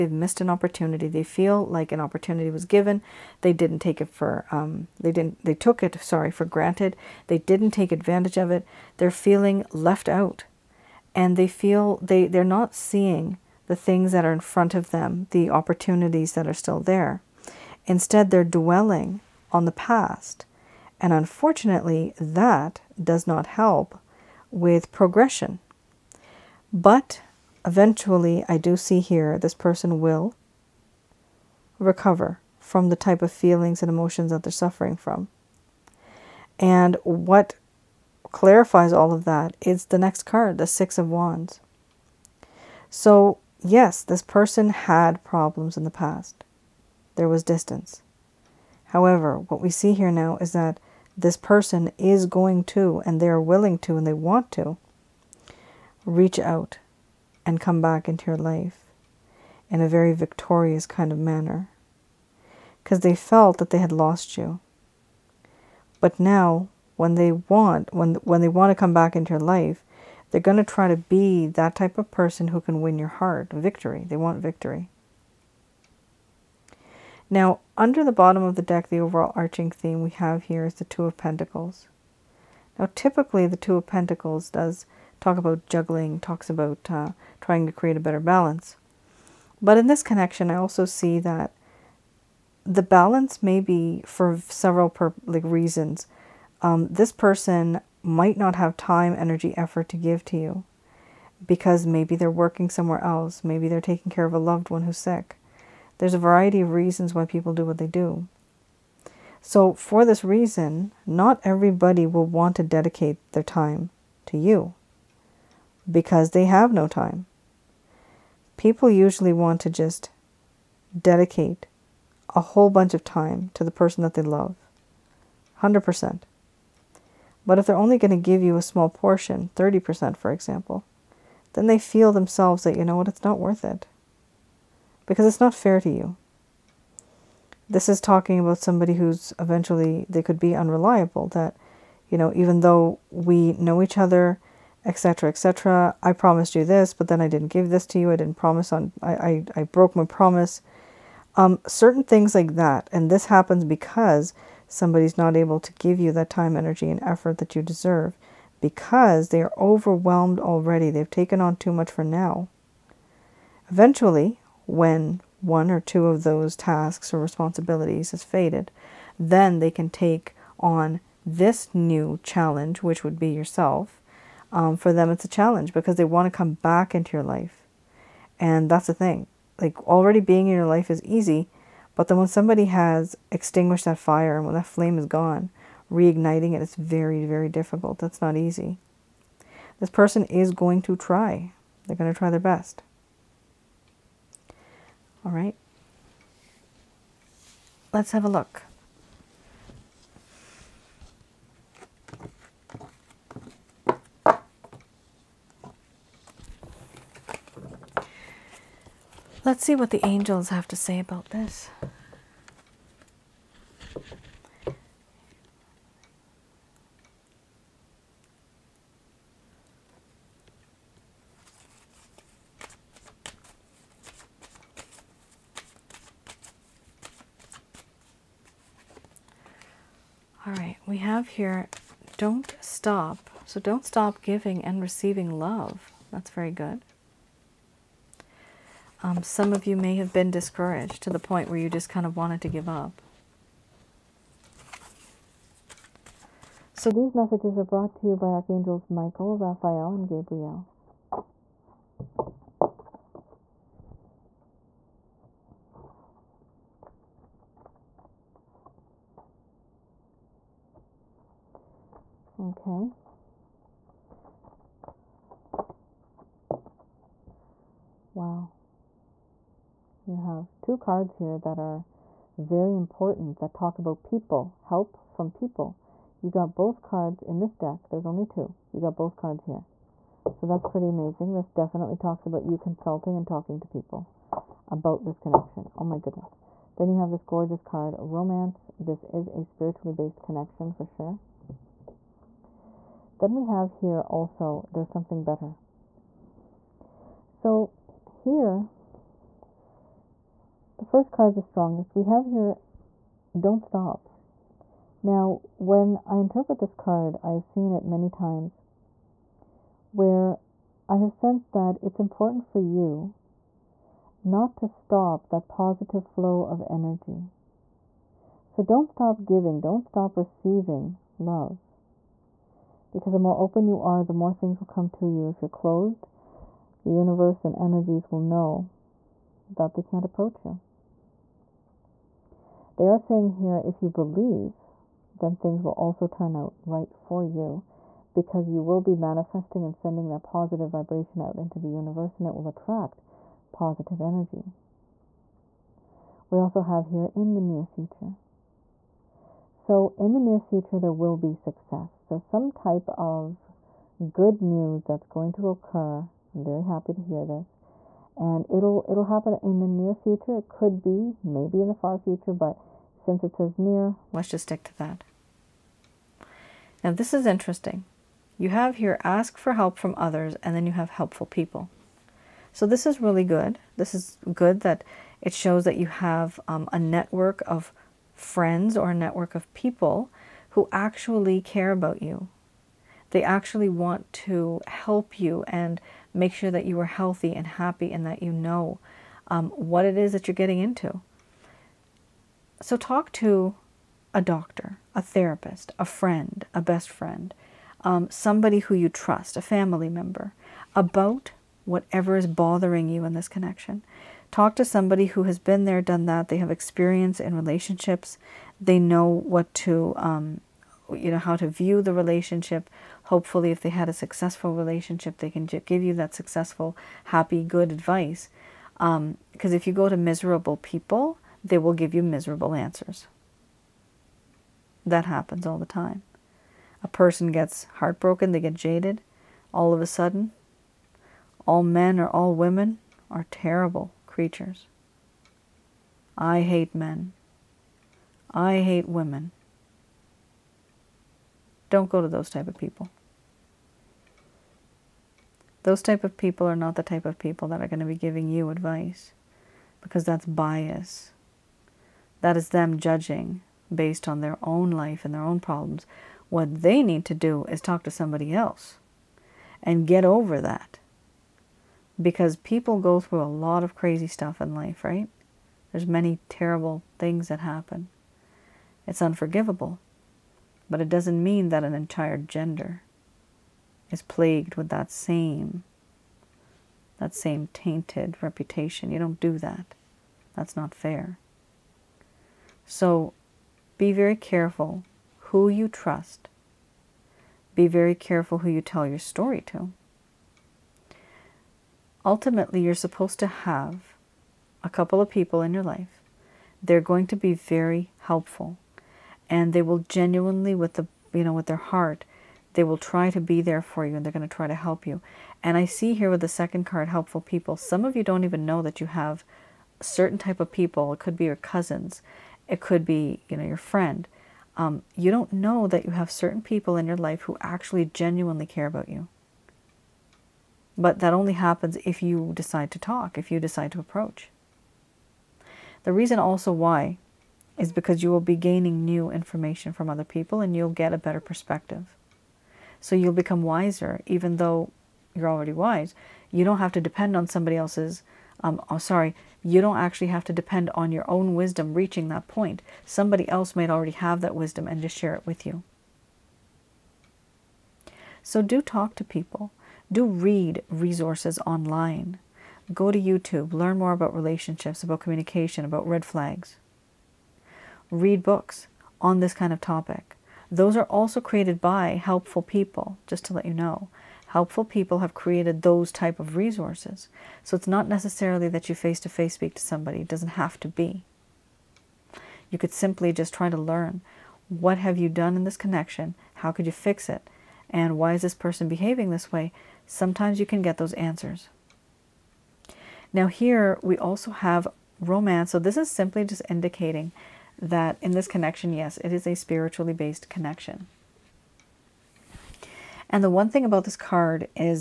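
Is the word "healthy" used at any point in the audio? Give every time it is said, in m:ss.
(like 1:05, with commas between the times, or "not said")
6:26.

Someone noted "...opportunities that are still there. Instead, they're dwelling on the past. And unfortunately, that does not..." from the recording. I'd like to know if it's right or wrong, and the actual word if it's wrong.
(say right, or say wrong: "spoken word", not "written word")
right.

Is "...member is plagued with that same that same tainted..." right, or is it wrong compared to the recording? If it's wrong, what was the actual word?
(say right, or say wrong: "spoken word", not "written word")
wrong: "gender", not "member".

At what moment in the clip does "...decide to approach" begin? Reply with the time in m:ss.
8:43.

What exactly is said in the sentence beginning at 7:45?
There's many terrible things that happen.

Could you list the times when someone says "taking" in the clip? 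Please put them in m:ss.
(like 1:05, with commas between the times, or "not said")
1:43.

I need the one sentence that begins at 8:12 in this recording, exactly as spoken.
Ultimately, you're supposed to have a couple of people in your life.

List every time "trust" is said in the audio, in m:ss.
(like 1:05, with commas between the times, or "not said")
6:38, 8:05.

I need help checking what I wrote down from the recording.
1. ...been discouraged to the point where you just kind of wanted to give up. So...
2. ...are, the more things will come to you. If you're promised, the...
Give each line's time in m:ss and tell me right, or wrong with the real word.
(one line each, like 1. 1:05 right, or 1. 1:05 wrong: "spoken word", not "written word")
1. 4:00 right
2. 5:23 wrong: "closed", not "promised".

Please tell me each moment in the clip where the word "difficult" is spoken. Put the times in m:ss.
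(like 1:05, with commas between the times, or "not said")
3:07.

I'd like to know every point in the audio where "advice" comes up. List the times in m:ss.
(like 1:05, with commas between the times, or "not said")
6:57, 7:28.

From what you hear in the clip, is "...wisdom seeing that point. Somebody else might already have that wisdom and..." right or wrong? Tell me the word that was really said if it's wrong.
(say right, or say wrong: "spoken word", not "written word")
wrong: "reaching", not "seeing".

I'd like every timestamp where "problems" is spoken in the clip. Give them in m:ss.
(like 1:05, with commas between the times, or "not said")
0:45, 7:35.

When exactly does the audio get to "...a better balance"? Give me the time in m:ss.
1:27.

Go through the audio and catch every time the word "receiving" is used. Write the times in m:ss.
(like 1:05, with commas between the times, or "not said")
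3:54, 5:20.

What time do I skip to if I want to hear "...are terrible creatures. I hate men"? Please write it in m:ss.
7:13.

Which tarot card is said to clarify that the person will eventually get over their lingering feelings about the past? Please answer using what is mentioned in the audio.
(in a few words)
Six of Wands.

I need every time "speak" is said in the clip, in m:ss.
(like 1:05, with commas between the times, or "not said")
9:29.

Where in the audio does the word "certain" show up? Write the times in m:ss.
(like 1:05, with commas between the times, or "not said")
2:31, 8:29, 8:36.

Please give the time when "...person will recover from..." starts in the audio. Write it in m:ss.
0:29.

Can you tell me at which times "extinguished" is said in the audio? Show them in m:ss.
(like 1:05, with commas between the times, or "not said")
3:03.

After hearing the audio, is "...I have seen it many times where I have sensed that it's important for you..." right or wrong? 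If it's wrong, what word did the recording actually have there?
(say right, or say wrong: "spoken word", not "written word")
right.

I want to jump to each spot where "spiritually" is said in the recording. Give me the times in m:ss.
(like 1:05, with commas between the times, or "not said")
4:49, 9:49.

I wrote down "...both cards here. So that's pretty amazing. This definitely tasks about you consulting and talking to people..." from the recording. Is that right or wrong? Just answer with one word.
wrong.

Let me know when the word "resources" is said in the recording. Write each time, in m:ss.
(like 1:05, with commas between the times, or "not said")
9:10, 9:26.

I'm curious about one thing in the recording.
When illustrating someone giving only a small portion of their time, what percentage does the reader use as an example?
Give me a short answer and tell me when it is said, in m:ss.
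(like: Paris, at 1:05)
30%, at 2:09.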